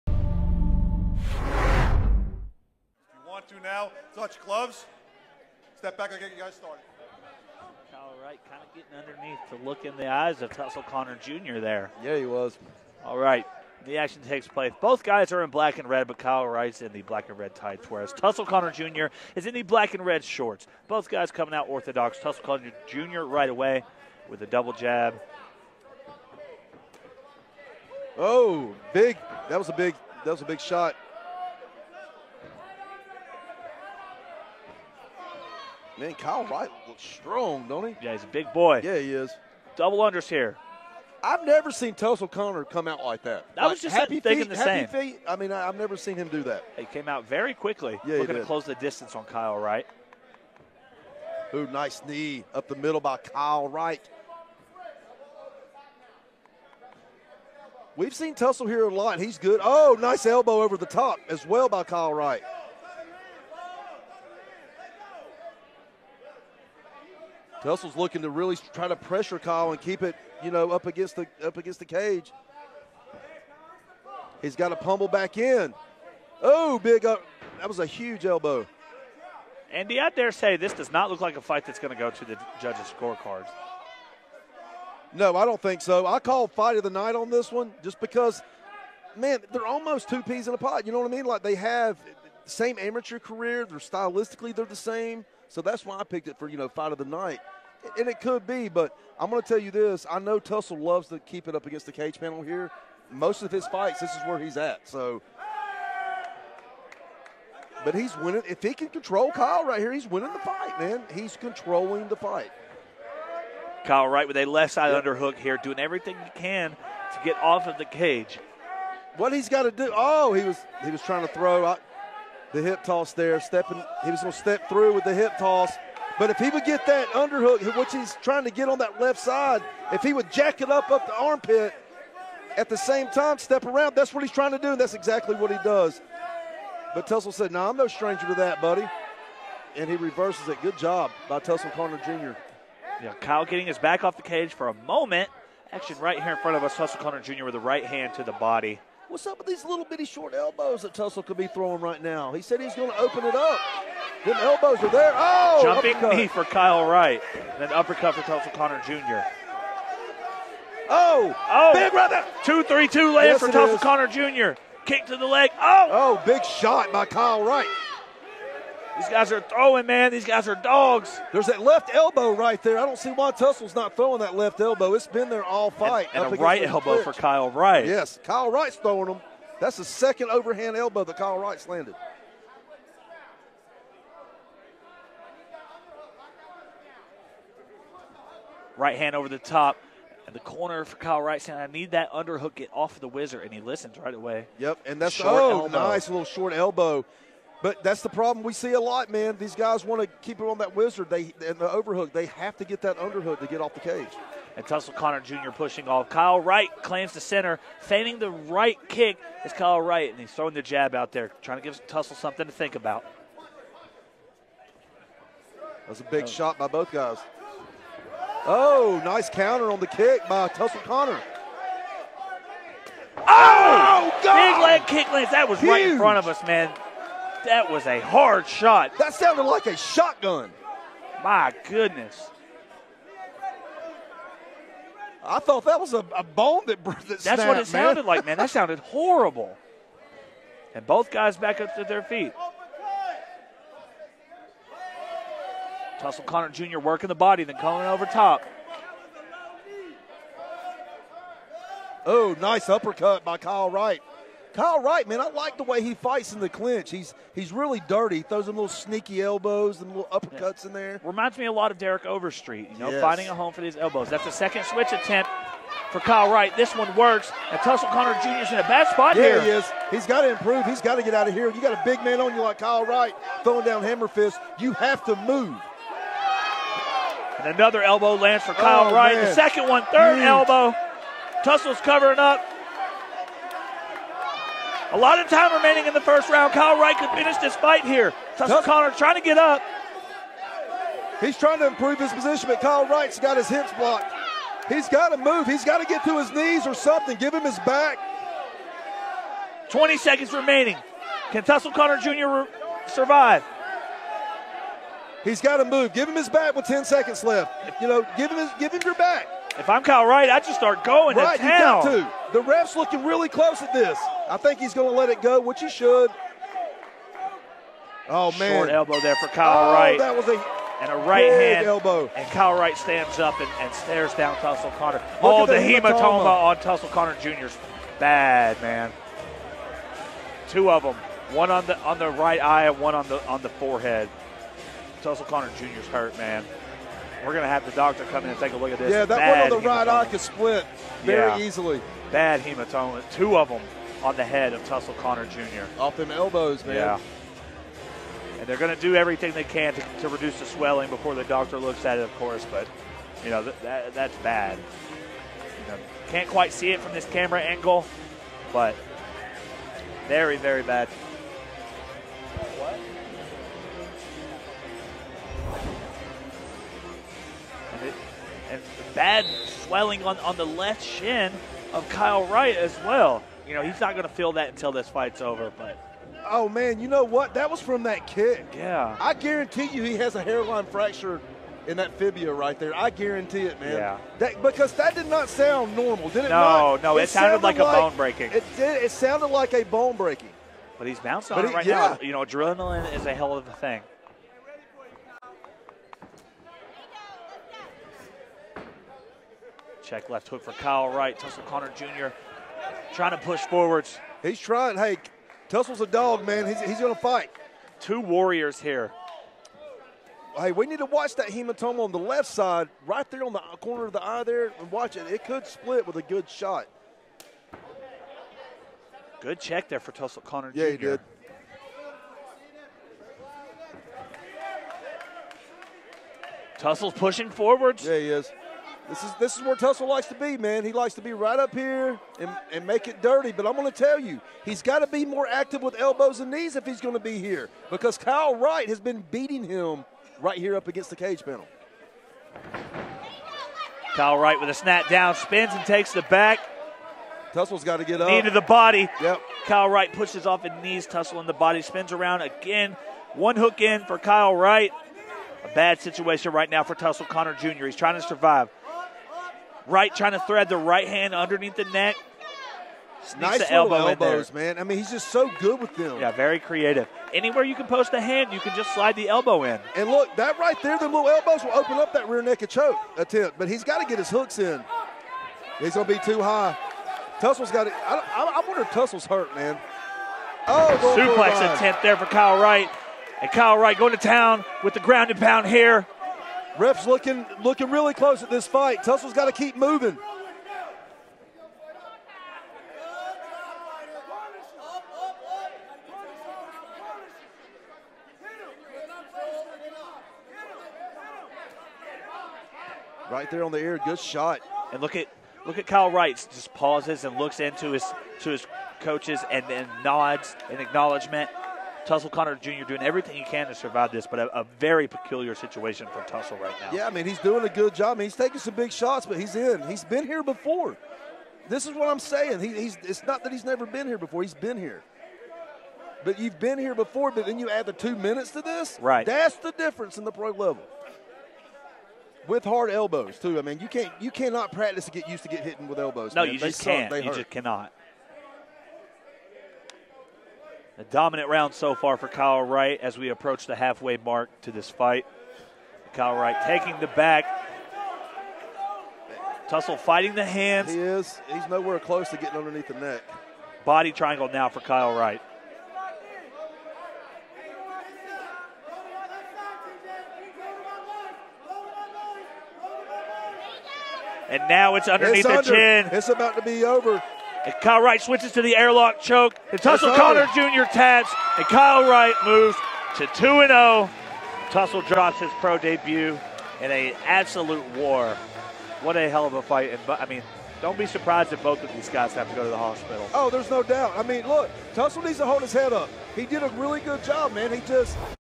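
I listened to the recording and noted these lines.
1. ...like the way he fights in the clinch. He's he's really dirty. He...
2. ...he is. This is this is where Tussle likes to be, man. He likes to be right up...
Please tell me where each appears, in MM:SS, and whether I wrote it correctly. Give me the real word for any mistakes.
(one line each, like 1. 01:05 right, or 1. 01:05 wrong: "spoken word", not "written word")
1. 04:15 right
2. 07:07 right.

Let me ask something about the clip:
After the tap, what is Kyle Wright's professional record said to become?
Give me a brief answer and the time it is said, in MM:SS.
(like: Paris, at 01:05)
2-0, at 09:33.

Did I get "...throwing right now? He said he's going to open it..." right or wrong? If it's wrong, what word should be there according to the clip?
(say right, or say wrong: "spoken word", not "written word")
right.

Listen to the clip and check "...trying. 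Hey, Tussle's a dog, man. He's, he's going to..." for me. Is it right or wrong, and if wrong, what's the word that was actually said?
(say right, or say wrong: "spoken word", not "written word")
right.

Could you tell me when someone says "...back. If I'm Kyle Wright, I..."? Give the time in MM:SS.
05:08.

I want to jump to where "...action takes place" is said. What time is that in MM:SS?
00:13.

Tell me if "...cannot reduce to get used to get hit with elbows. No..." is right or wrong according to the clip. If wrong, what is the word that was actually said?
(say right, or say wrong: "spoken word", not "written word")
wrong: "practice", not "reduce".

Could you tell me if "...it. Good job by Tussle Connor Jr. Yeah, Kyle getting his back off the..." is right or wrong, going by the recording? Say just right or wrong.
right.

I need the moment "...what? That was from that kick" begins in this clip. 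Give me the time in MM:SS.
06:17.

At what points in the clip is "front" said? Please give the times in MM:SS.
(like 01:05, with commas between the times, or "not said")
02:26, 03:45.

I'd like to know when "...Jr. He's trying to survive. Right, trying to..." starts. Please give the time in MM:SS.
07:37.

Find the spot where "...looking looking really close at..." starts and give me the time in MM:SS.
08:06.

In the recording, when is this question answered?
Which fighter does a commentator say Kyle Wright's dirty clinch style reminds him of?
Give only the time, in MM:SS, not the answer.
04:21.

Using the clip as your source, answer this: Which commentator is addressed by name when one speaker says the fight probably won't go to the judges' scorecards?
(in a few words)
Andy.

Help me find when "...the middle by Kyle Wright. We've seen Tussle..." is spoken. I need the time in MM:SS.
00:52.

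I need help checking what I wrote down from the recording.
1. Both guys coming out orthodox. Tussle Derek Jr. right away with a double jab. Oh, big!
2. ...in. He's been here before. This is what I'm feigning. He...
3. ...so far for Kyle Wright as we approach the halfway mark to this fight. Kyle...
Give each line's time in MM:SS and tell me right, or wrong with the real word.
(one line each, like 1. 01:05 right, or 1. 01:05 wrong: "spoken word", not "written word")
1. 00:20 wrong: "Connor", not "Derek"
2. 08:39 wrong: "saying", not "feigning"
3. 09:01 right.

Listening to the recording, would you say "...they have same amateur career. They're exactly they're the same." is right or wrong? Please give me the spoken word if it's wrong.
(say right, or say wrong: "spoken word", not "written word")
wrong: "stylistically", not "exactly".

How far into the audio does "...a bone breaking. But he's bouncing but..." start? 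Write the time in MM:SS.
06:29.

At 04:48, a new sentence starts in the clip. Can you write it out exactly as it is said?
Tussle Connor trying to get up.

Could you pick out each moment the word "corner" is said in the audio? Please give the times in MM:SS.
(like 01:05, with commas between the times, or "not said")
03:10, 06:53.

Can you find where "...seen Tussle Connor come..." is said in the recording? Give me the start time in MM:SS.
00:41.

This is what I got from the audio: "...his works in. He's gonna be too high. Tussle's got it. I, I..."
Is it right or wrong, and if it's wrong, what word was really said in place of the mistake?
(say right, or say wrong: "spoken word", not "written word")
wrong: "hooks", not "works".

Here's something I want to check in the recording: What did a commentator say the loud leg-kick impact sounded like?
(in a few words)
A shotgun.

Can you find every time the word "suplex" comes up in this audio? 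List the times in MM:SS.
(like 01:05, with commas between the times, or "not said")
08:00.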